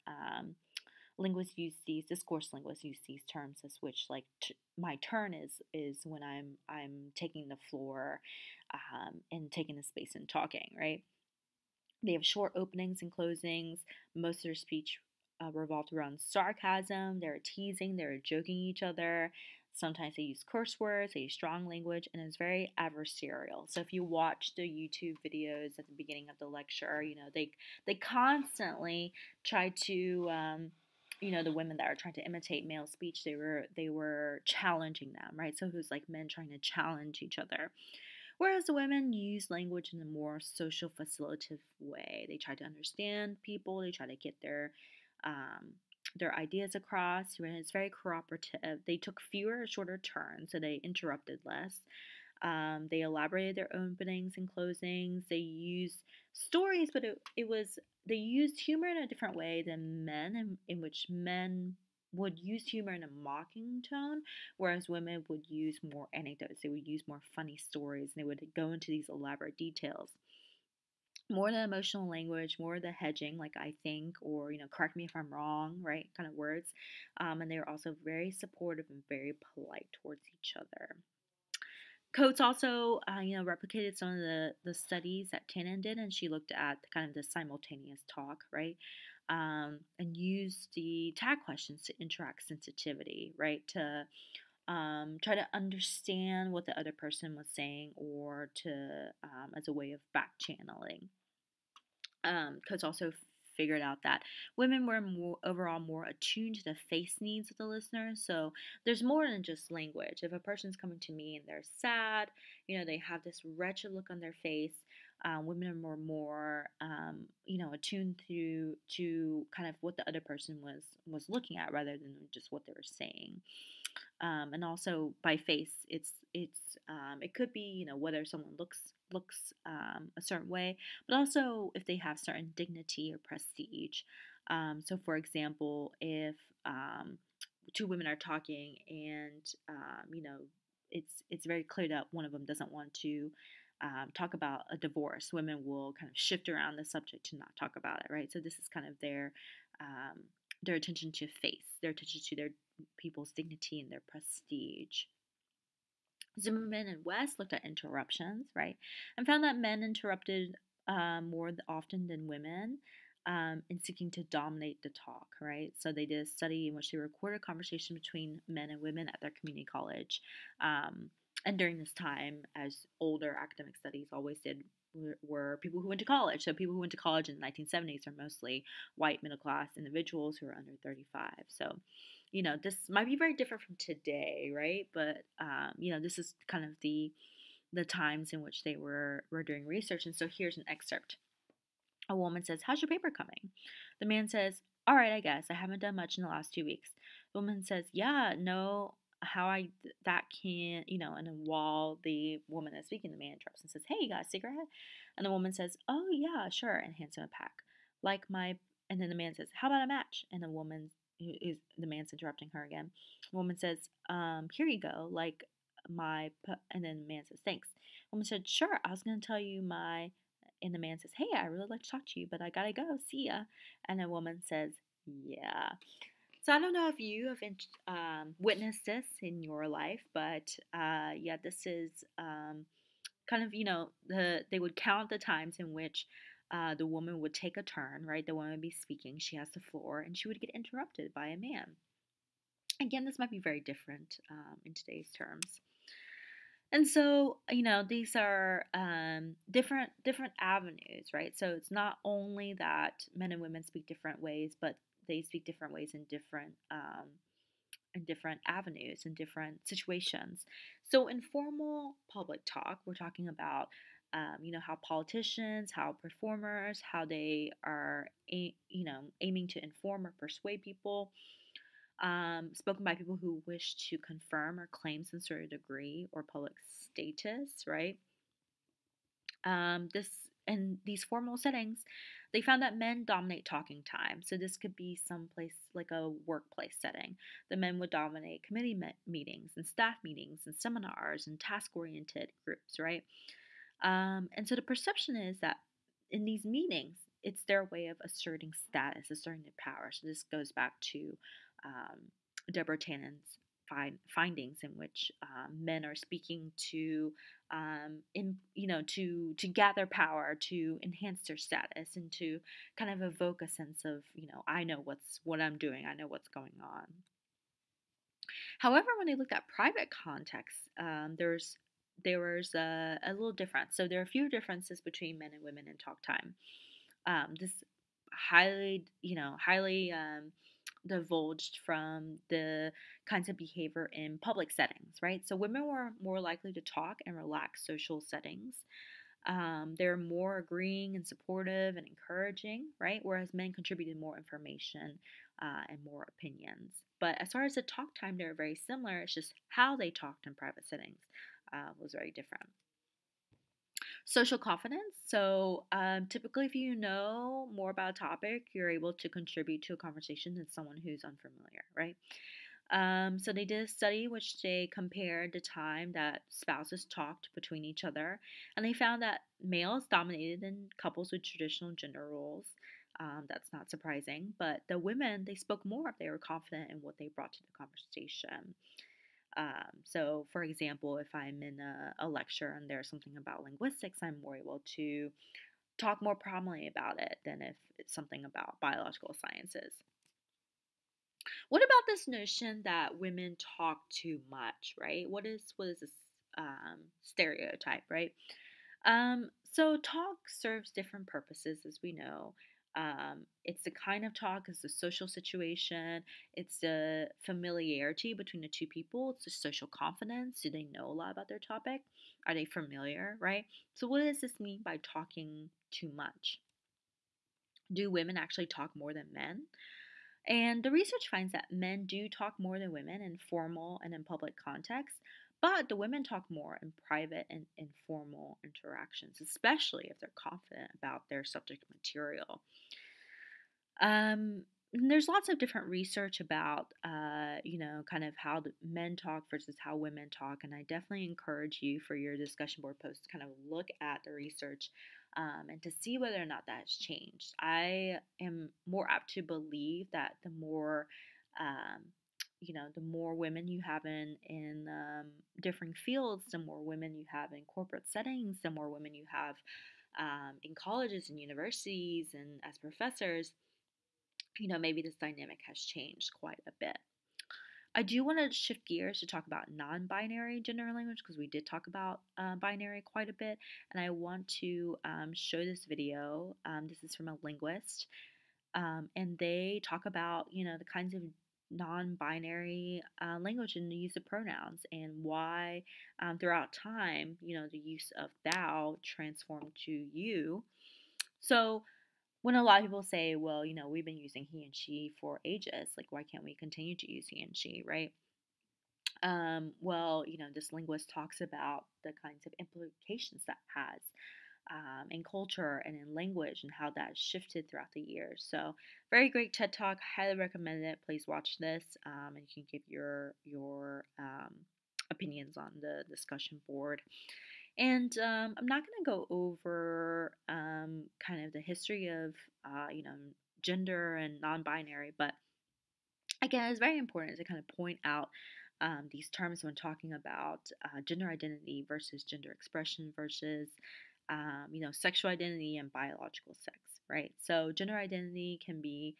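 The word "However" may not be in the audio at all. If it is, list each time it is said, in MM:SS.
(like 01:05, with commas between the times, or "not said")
05:18.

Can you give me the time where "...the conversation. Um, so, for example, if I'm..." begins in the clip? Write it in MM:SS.
06:17.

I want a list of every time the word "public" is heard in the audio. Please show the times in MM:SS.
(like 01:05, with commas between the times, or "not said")
04:22, 04:36, 05:34, 07:04.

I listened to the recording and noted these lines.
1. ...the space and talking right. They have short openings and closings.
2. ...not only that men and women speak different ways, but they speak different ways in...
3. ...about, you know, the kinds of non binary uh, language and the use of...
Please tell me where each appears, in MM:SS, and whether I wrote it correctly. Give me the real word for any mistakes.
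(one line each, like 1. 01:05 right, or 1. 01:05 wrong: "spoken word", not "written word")
1. 00:09 right
2. 04:11 right
3. 07:59 right.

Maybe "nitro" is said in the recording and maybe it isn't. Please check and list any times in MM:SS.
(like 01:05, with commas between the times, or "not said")
not said.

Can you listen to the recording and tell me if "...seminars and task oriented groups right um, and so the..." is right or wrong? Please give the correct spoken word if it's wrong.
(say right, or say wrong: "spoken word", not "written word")
right.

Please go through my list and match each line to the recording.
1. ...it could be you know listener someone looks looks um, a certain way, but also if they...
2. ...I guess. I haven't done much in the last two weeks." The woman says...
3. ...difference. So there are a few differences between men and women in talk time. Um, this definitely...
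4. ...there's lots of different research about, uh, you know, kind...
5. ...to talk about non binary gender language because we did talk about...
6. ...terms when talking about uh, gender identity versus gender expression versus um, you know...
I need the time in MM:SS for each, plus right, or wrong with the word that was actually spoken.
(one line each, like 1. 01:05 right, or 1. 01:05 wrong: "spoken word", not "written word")
1. 02:07 wrong: "whether", not "listener"
2. 03:15 right
3. 05:23 wrong: "highly", not "definitely"
4. 07:14 right
5. 07:49 right
6. 08:49 right.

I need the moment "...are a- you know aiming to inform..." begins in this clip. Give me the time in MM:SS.
04:27.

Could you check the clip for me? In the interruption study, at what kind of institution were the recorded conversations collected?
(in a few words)
community college.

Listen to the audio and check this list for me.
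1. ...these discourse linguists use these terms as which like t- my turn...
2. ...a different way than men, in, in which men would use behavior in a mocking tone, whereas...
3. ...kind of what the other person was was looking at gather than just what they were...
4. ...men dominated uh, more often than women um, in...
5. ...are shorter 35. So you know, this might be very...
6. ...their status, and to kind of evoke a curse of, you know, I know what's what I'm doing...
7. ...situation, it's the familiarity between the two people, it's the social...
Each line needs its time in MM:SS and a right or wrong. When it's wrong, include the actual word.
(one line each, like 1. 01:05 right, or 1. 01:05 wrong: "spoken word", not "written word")
1. 00:01 right
2. 00:58 wrong: "humor", not "behavior"
3. 01:59 wrong: "rather", not "gather"
4. 02:39 wrong: "interrupted", not "dominated"
5. 03:00 wrong: "under", not "shorter"
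6. 05:11 wrong: "sense", not "curse"
7. 06:45 right.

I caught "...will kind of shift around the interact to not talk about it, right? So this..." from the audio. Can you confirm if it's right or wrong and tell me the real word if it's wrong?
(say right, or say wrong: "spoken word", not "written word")
wrong: "subject", not "interact".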